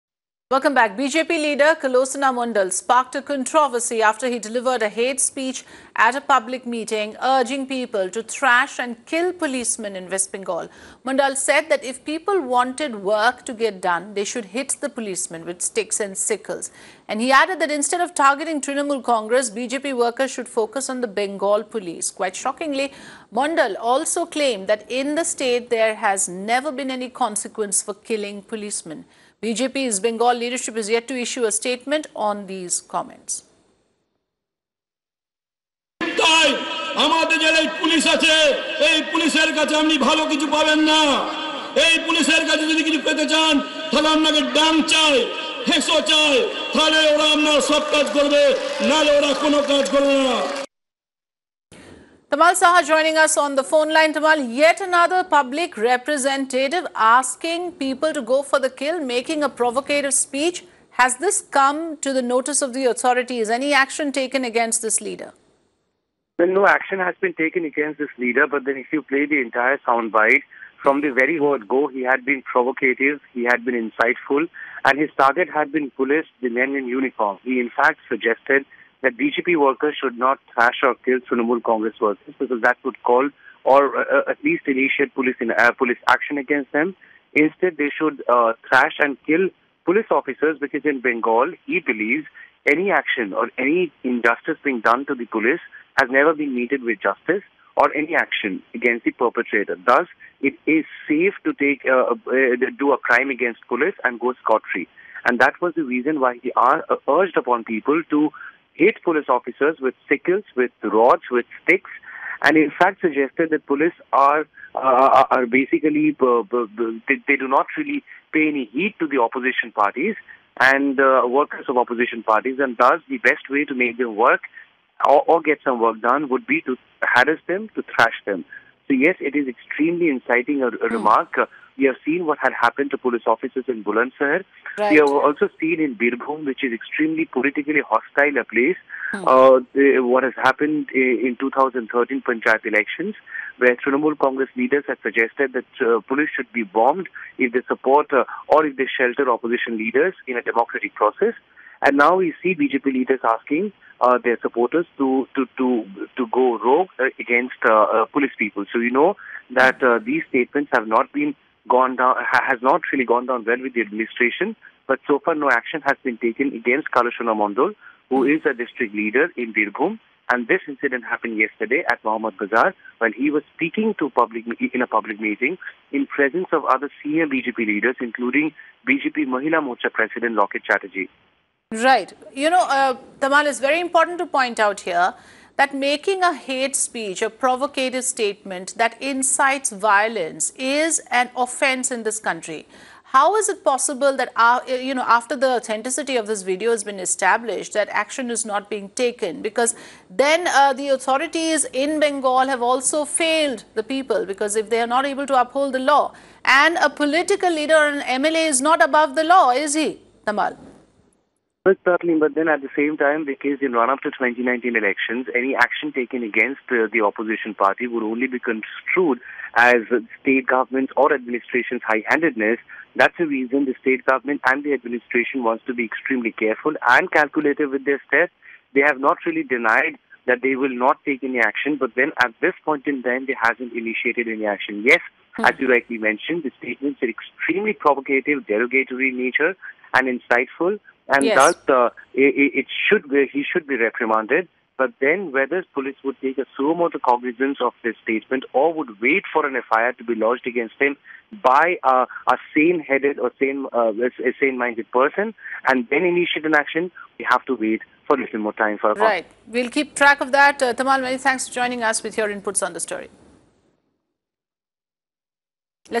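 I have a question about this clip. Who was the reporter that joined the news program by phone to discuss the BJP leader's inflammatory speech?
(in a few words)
Tamal Saha.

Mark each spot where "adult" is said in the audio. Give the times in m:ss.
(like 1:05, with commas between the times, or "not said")
not said.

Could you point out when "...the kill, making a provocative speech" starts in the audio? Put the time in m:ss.
0:58.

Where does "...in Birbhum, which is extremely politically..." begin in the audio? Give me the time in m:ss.
2:15.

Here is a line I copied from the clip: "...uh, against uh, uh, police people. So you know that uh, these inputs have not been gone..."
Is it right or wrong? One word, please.
wrong.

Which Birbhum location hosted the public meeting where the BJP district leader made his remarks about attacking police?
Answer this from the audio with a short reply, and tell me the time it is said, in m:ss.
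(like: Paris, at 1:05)
Mohammad Bazar, at 2:52.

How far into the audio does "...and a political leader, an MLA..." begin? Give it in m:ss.
3:26.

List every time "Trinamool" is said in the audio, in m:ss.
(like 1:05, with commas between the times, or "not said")
0:18, 1:21, 2:23.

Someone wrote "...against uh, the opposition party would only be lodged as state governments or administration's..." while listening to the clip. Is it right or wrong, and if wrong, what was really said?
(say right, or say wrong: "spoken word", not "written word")
wrong: "construed", not "lodged".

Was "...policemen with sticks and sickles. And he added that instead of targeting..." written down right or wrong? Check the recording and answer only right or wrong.
right.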